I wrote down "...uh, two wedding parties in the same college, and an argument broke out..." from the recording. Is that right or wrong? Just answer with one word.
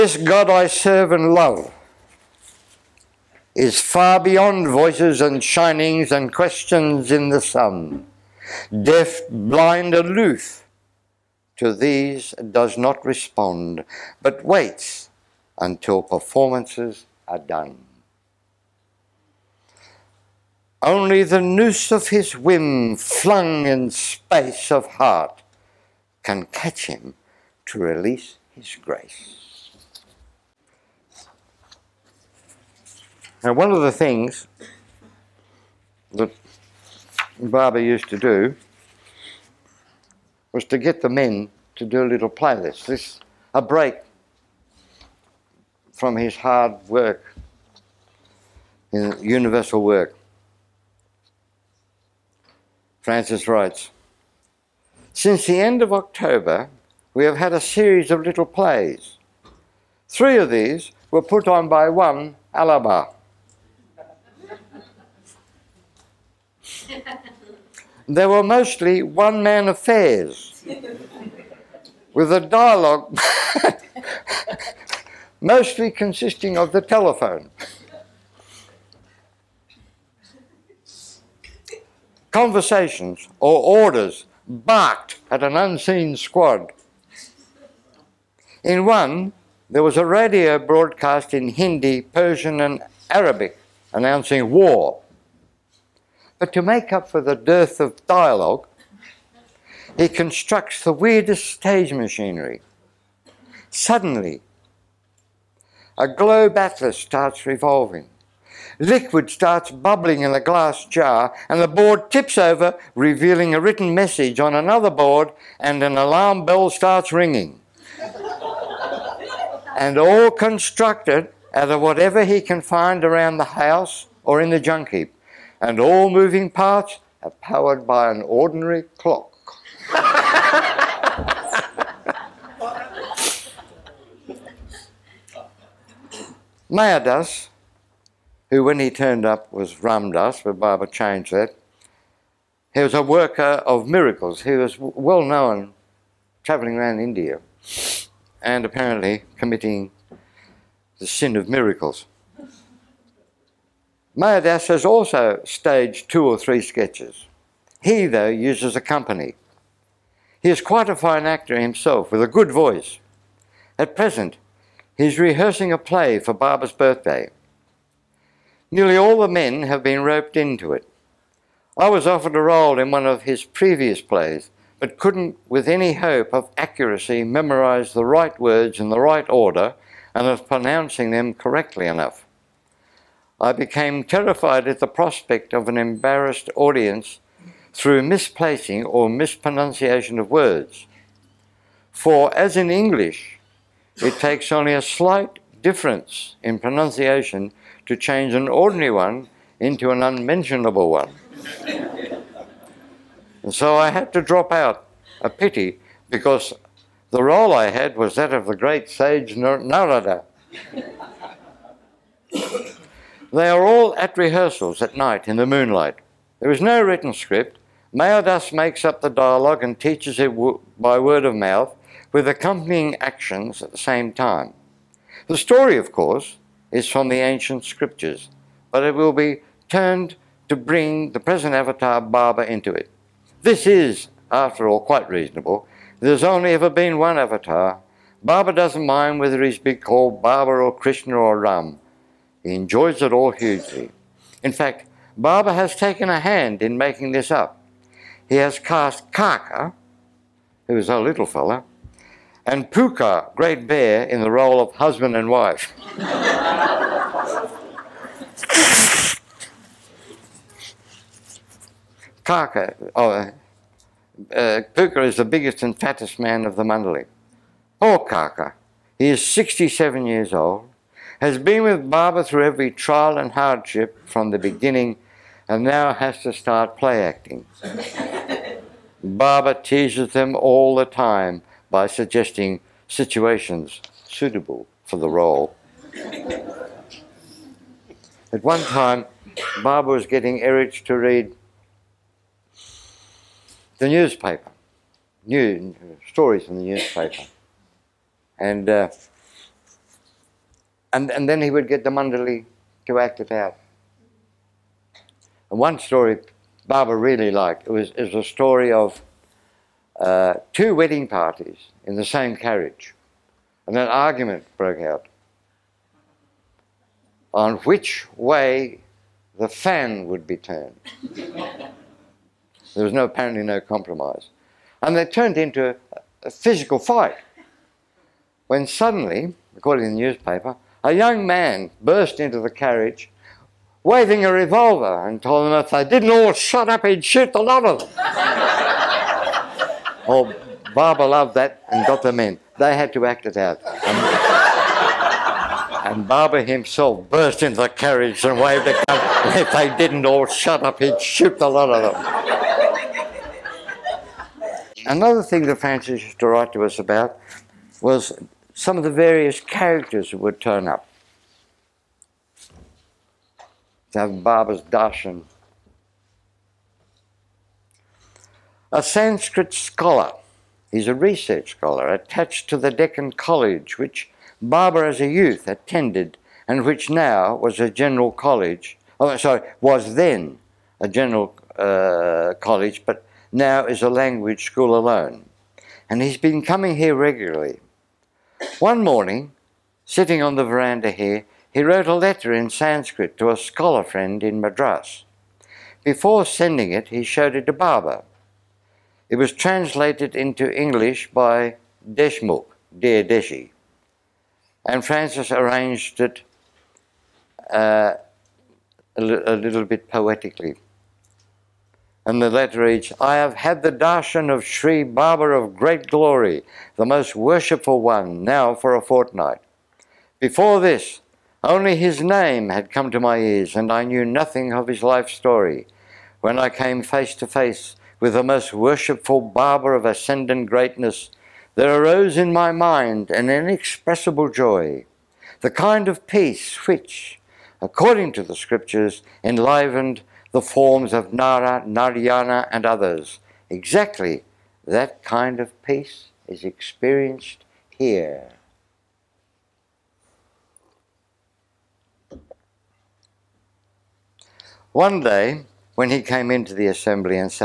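wrong.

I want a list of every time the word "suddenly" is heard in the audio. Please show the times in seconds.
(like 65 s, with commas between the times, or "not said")
103 s, 328 s.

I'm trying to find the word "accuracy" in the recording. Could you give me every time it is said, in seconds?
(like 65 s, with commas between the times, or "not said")
176 s.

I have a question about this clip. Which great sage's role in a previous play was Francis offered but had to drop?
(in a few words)
Narada.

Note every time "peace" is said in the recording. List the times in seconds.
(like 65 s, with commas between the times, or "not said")
436 s, 445 s.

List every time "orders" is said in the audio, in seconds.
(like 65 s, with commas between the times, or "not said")
83 s, 179 s.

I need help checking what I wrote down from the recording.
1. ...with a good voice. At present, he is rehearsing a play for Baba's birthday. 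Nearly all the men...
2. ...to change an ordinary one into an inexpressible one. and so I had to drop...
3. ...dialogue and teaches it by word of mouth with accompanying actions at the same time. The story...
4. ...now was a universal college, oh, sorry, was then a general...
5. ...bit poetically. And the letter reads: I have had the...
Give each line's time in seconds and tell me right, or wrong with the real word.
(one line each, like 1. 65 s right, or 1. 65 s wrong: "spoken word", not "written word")
1. 162 s right
2. 197 s wrong: "unmentionable", not "inexpressible"
3. 219 s right
4. 376 s wrong: "general", not "universal"
5. 409 s right.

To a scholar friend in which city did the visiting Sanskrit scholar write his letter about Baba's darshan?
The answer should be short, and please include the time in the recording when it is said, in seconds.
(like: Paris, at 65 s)
Madras, at 394 s.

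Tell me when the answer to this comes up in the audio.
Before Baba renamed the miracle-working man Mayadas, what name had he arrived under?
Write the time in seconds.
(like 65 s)
139 s.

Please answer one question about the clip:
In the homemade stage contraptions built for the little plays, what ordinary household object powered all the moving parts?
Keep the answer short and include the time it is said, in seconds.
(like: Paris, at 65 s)
an ordinary clock, at 128 s.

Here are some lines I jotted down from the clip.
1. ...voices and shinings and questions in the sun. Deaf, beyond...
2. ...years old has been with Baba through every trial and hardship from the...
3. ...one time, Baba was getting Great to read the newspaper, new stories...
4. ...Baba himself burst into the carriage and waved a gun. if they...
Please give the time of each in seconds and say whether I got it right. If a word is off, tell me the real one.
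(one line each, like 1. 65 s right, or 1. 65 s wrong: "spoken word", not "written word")
1. 4 s wrong: "blind", not "beyond"
2. 270 s right
3. 288 s wrong: "Eruch", not "Great"
4. 346 s right.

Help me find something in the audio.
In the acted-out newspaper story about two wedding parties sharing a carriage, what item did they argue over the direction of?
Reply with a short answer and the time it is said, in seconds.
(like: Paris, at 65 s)
the fan, at 319 s.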